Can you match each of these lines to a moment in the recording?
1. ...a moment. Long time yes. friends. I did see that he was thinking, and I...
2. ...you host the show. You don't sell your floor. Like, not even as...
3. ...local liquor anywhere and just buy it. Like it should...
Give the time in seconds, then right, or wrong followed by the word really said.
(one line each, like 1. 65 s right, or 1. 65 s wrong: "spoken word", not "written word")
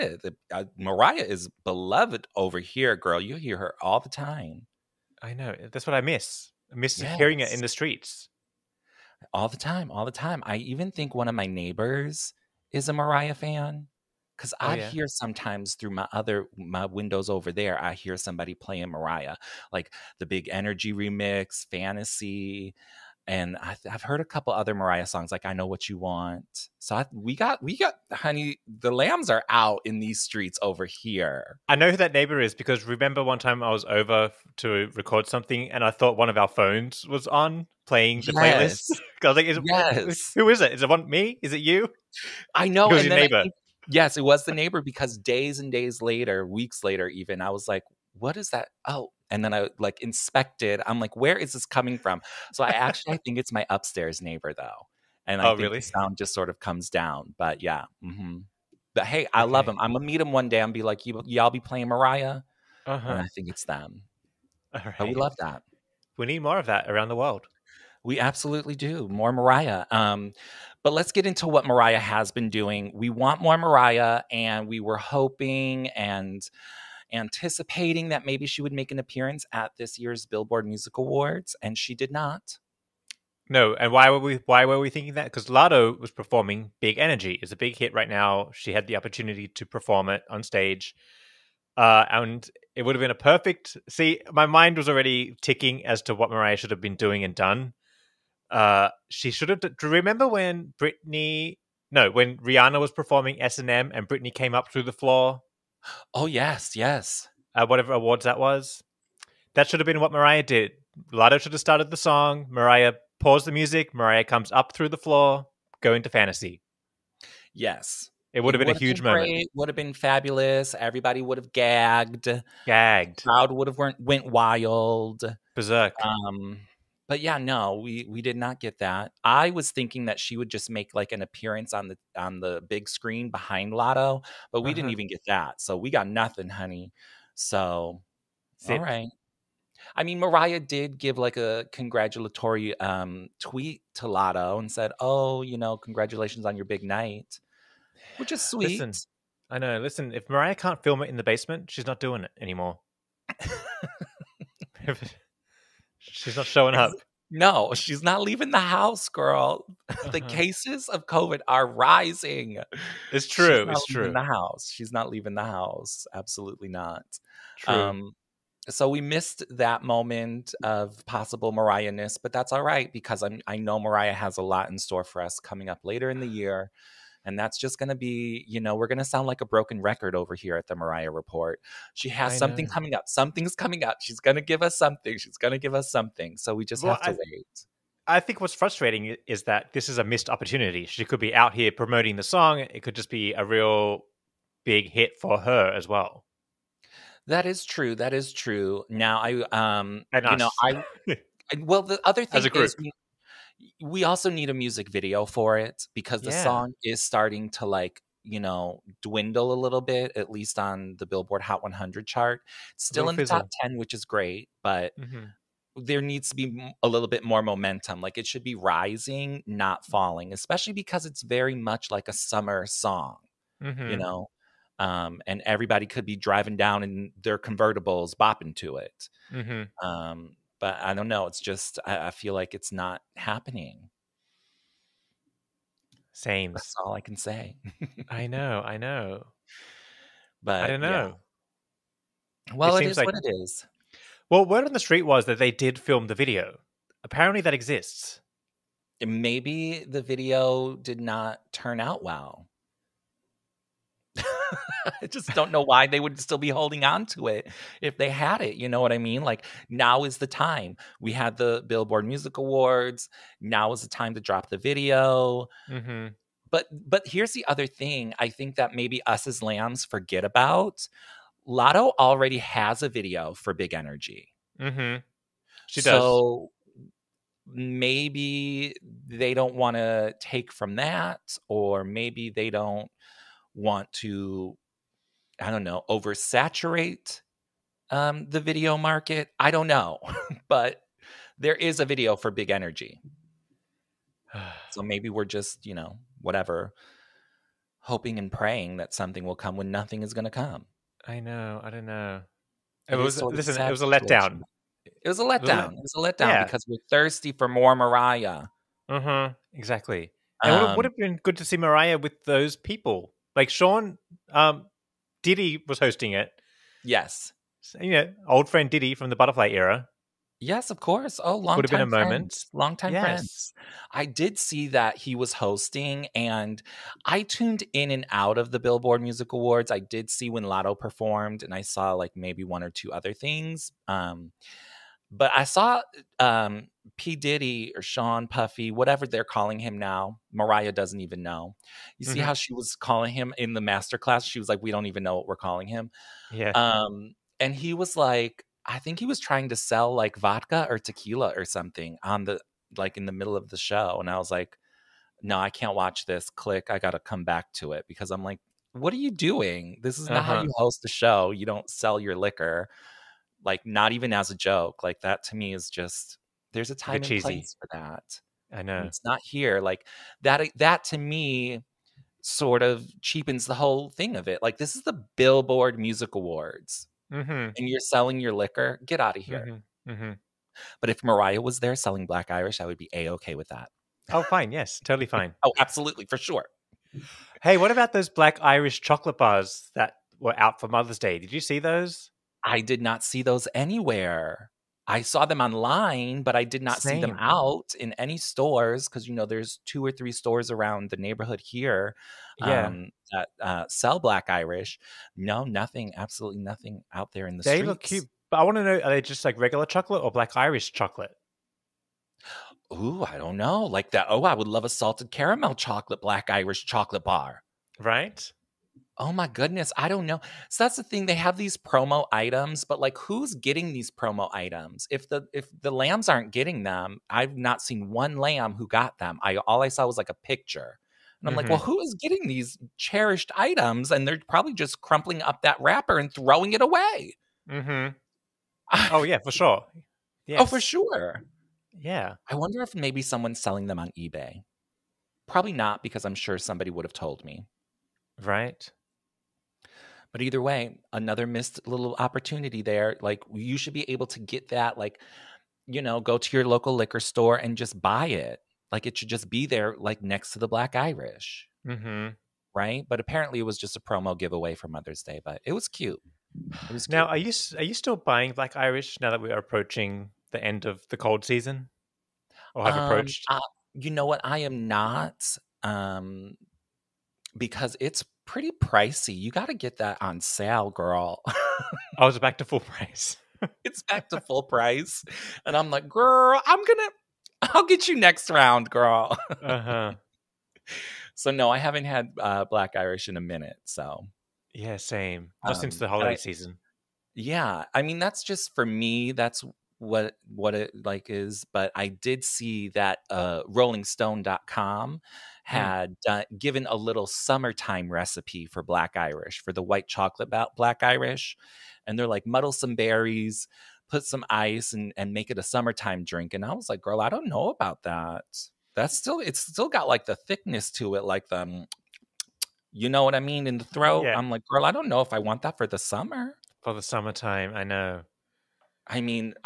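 1. 321 s wrong: "hosting", not "thinking"
2. 360 s wrong: "liquor", not "floor"
3. 456 s wrong: "store", not "anywhere".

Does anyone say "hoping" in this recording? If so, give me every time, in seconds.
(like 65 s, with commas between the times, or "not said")
74 s, 297 s.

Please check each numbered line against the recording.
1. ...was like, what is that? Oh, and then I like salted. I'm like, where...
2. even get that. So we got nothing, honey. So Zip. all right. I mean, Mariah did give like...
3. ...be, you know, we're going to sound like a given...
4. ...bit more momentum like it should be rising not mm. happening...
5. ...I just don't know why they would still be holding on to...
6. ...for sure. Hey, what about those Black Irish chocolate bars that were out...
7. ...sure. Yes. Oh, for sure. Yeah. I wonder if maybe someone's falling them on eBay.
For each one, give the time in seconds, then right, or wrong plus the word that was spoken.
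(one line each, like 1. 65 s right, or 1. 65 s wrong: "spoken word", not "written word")
1. 47 s wrong: "inspected", not "salted"
2. 134 s right
3. 177 s wrong: "broken", not "given"
4. 217 s wrong: "falling", not "happening"
5. 255 s right
6. 386 s right
7. 439 s wrong: "selling", not "falling".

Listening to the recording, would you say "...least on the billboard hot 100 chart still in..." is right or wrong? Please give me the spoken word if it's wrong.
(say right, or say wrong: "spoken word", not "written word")
right.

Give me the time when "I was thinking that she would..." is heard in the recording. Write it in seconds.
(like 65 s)
129 s.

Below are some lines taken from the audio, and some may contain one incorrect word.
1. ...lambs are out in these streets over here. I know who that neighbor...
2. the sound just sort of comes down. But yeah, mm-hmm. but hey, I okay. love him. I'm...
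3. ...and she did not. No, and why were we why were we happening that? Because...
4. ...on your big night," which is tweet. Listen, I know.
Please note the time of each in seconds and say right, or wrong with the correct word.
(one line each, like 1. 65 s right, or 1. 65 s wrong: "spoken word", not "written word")
1. 28 s right
2. 55 s right
3. 81 s wrong: "thinking", not "happening"
4. 146 s wrong: "sweet", not "tweet".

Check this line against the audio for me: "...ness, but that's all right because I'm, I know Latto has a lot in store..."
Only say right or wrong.
wrong.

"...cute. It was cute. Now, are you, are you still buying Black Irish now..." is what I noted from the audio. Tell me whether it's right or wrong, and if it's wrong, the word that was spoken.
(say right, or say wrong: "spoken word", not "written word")
right.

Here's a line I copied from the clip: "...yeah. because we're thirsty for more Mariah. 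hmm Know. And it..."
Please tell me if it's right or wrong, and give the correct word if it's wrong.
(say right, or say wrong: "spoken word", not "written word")
wrong: "Exactly", not "Know".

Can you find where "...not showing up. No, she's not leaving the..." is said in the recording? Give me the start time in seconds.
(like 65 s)
156 s.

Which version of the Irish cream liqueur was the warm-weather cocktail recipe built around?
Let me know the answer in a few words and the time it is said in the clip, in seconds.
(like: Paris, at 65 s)
White chocolate, at 509 s.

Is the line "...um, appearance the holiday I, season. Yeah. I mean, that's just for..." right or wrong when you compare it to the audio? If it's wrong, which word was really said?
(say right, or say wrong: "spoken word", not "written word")
wrong: "since", not "appearance".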